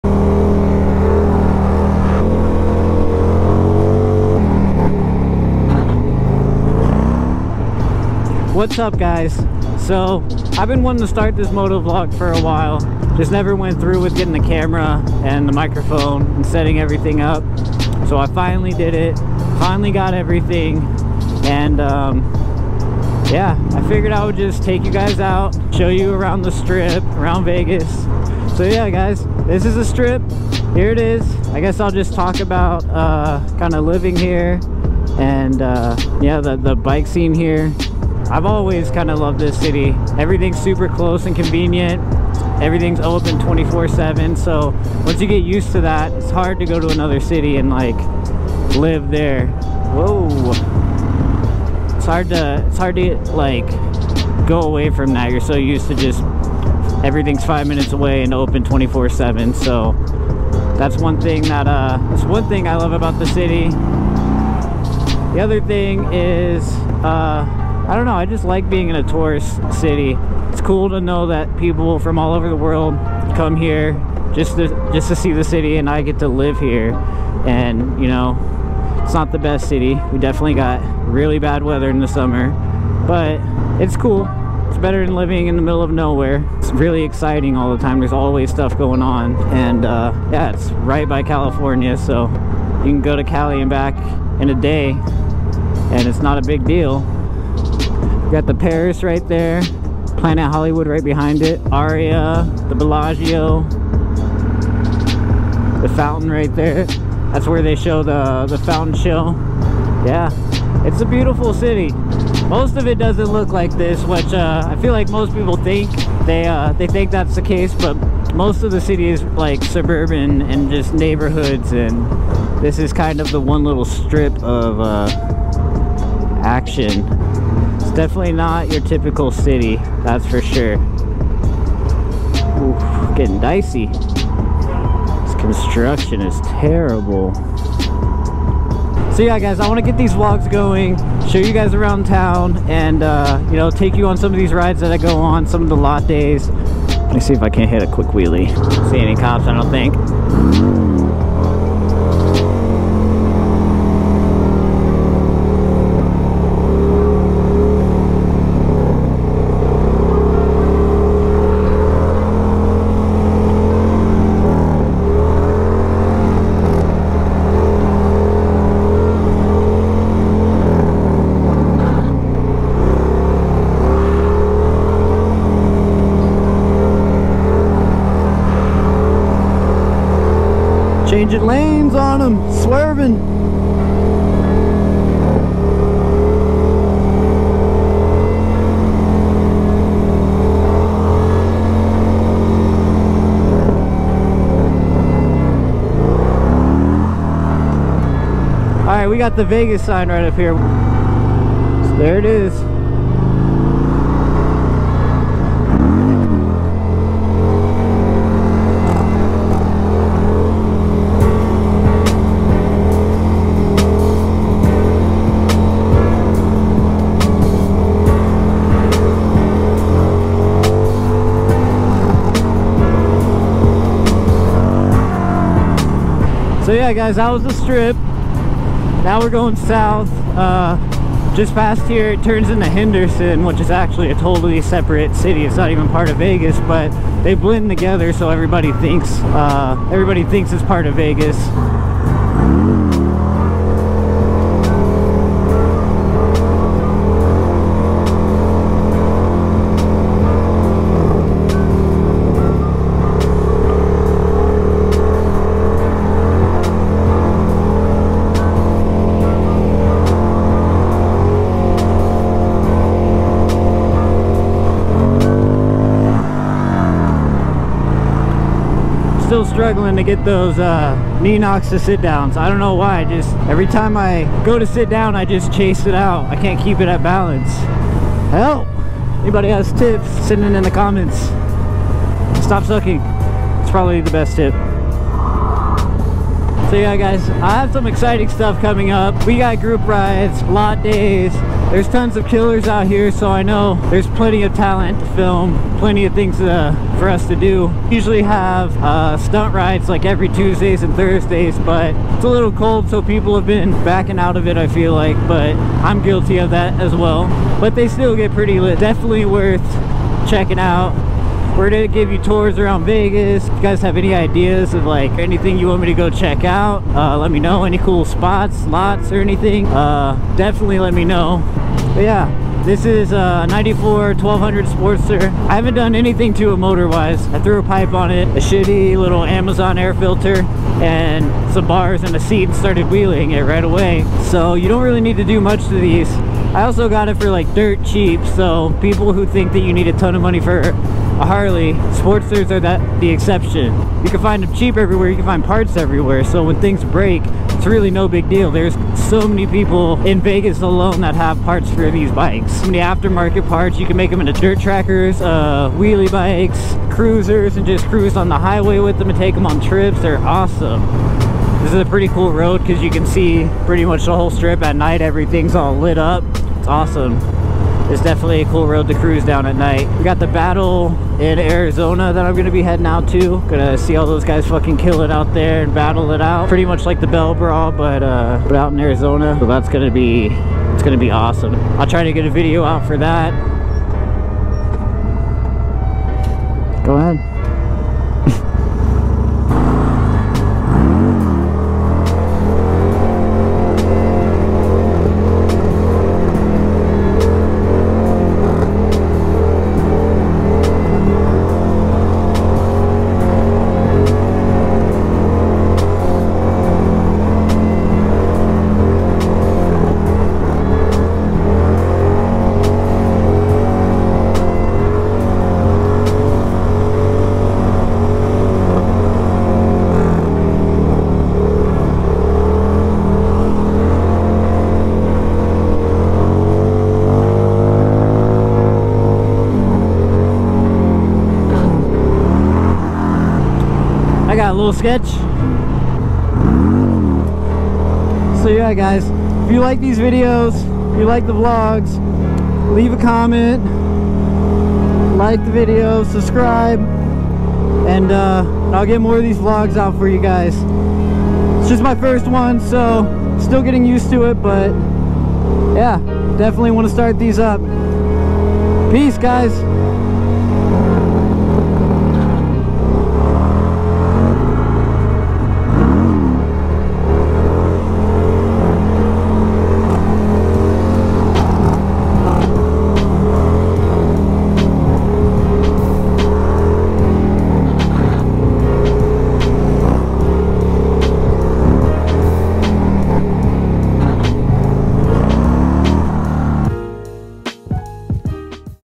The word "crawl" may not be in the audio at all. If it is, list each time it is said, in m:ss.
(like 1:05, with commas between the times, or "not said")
not said.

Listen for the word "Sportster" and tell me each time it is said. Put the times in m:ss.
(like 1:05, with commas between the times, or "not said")
5:24, 5:41.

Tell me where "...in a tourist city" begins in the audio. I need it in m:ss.
1:08.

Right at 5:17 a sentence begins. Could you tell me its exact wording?
Any cool spots, lots, or anything, uh, definitely let me know.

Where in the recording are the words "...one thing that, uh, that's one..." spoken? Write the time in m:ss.
1:00.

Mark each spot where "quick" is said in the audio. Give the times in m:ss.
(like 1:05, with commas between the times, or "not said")
2:27.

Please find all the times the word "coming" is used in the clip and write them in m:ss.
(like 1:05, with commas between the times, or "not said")
4:48.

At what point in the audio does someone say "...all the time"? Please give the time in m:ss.
1:27.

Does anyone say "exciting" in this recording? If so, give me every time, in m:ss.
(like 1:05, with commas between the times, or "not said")
1:27, 4:47.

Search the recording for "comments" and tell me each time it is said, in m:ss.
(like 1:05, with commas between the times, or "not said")
4:40, 7:22.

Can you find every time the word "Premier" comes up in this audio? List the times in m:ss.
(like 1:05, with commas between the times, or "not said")
not said.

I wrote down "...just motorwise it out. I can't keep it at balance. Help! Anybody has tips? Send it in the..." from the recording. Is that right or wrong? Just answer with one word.
wrong.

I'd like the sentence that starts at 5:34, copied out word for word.
So you don't really need to do much to these.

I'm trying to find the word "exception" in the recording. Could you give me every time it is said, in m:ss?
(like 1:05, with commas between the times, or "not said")
5:43.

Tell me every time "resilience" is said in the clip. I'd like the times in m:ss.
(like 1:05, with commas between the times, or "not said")
not said.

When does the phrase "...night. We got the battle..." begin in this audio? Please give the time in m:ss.
6:09.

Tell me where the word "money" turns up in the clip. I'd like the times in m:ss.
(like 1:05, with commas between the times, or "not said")
5:40.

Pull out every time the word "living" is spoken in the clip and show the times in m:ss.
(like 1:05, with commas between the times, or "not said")
0:33, 1:25.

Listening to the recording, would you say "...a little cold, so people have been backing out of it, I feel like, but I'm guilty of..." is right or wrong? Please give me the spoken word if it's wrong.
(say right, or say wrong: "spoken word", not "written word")
right.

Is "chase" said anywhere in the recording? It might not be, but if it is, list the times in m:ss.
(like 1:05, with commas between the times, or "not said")
4:35.